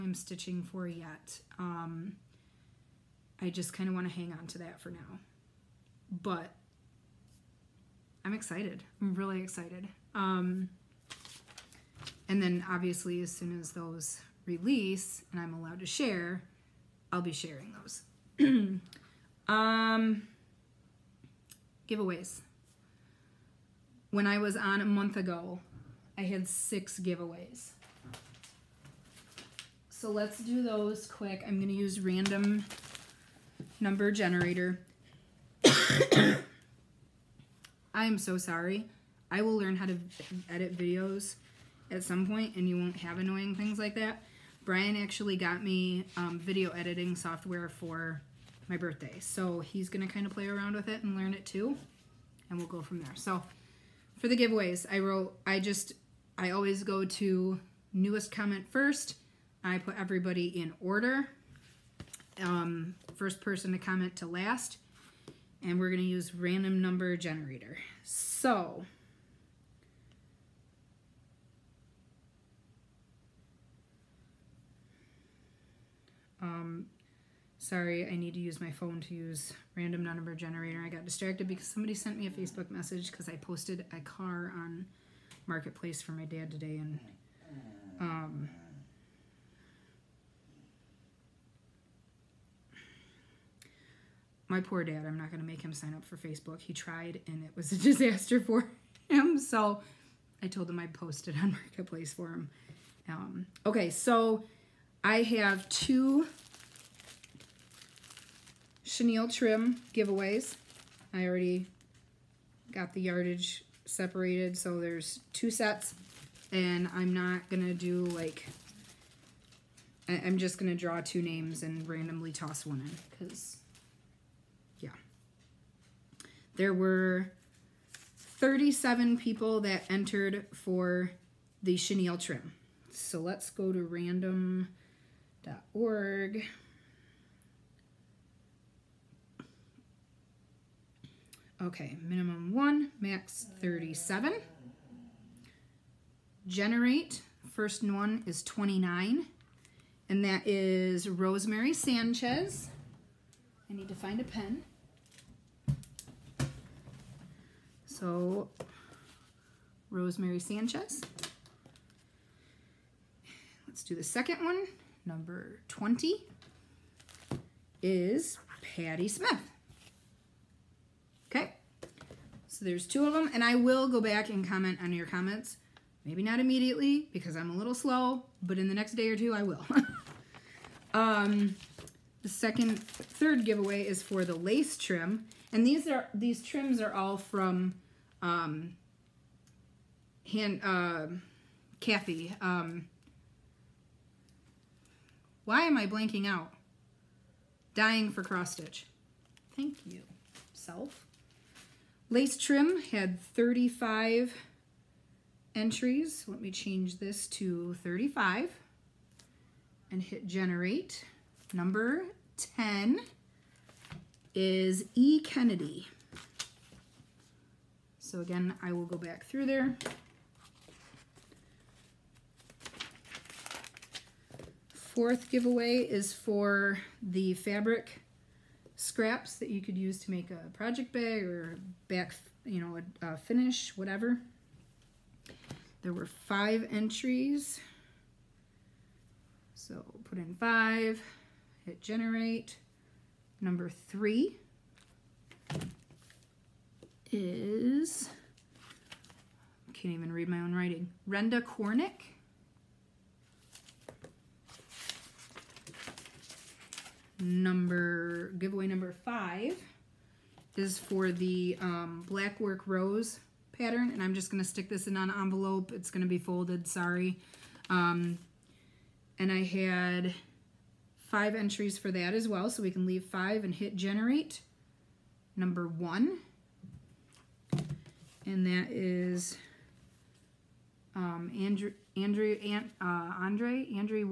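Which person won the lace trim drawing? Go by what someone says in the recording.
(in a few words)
E. Kennedy.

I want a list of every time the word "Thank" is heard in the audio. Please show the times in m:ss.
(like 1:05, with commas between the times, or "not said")
3:19.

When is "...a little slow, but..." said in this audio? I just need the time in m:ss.
2:57.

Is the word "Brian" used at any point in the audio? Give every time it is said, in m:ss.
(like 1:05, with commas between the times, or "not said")
0:44.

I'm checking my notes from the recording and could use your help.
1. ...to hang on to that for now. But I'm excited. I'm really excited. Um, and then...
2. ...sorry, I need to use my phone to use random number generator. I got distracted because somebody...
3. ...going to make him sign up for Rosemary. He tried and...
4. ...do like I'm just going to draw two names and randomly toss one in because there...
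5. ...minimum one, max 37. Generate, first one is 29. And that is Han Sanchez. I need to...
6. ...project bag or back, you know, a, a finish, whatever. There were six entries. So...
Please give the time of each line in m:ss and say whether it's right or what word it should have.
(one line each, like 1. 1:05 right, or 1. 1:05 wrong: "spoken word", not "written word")
1. 0:04 right
2. 1:17 right
3. 1:35 wrong: "Facebook", not "Rosemary"
4. 1:57 right
5. 2:22 wrong: "Rosemary", not "Han"
6. 3:50 wrong: "five", not "six".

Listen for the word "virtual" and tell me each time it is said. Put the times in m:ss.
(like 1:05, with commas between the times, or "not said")
not said.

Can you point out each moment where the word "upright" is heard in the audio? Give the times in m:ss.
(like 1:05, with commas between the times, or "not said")
not said.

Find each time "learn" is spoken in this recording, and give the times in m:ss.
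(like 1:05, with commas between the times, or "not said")
0:39, 0:51.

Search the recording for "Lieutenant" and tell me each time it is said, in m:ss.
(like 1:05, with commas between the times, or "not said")
not said.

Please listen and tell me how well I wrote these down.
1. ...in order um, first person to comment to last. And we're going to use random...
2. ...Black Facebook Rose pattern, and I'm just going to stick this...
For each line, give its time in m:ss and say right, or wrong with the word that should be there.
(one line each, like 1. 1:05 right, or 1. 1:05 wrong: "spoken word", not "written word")
1. 1:00 right
2. 4:22 wrong: "Work", not "Facebook".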